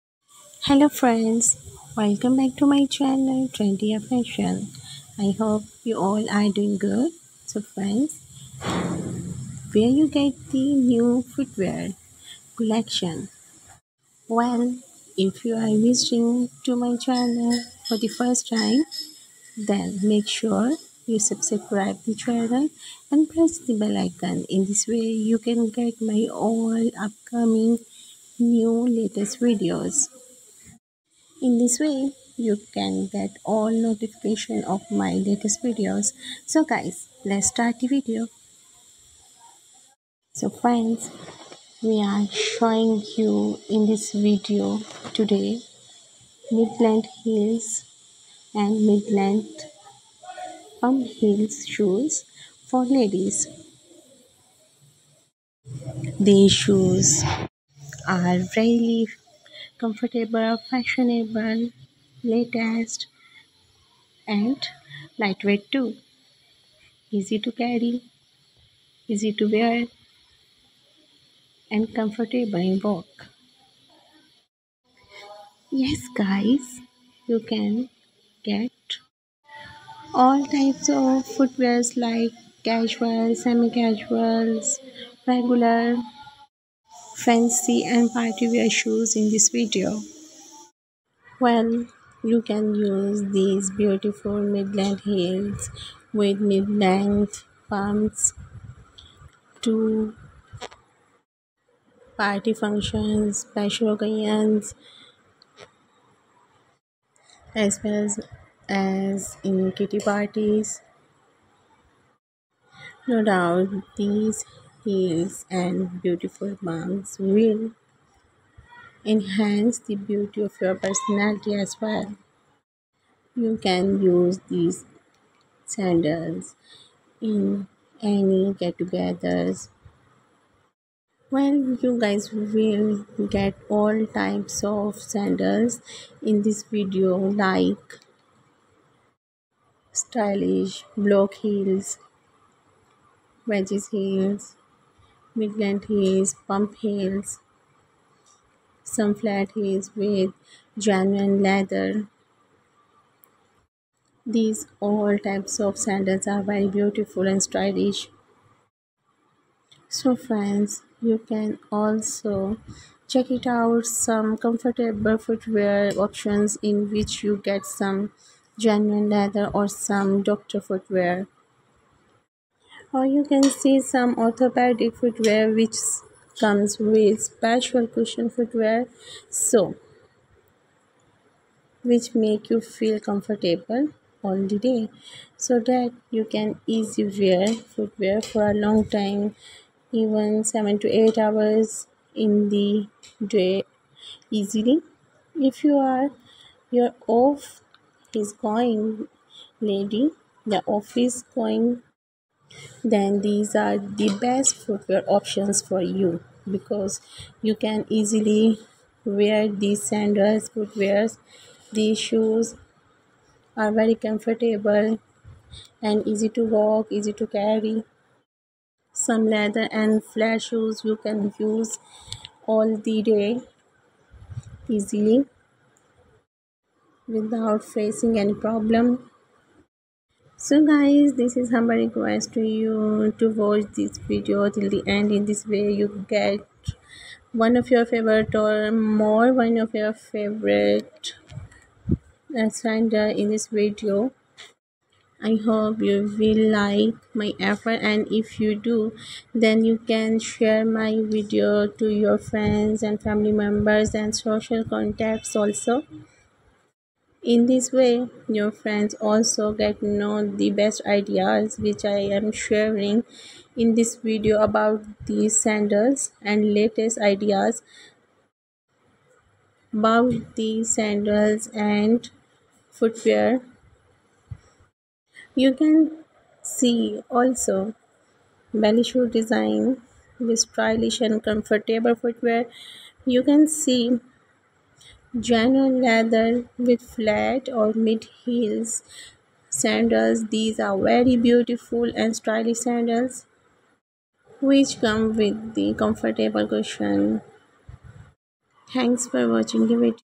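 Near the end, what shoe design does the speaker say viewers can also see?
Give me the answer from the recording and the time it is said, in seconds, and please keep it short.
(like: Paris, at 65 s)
Belly shoe, at 278 s.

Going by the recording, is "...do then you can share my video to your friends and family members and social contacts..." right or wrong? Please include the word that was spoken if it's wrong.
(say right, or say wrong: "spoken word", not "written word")
right.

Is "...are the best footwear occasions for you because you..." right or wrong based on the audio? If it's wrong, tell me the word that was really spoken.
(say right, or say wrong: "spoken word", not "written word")
wrong: "options", not "occasions".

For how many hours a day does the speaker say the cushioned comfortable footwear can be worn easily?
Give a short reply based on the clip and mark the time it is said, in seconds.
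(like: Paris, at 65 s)
7 to 8 hours, at 190 s.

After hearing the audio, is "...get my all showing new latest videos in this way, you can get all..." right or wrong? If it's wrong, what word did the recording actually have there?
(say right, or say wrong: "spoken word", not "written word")
wrong: "upcoming", not "showing".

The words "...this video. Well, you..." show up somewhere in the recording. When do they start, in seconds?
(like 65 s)
89 s.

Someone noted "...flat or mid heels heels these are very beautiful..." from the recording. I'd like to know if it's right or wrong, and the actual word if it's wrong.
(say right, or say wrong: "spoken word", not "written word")
wrong: "sandals", not "heels".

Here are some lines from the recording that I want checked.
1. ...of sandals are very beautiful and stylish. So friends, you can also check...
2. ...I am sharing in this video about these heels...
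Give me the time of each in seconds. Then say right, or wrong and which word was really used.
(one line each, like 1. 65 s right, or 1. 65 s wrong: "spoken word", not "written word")
1. 155 s right
2. 261 s wrong: "sandals", not "heels".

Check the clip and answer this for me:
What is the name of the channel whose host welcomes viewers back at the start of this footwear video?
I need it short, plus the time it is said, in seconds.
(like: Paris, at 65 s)
Trendy Fashion, at 3 s.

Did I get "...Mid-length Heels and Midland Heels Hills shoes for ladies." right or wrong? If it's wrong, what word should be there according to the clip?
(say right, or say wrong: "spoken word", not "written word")
wrong: "Palm", not "Heels".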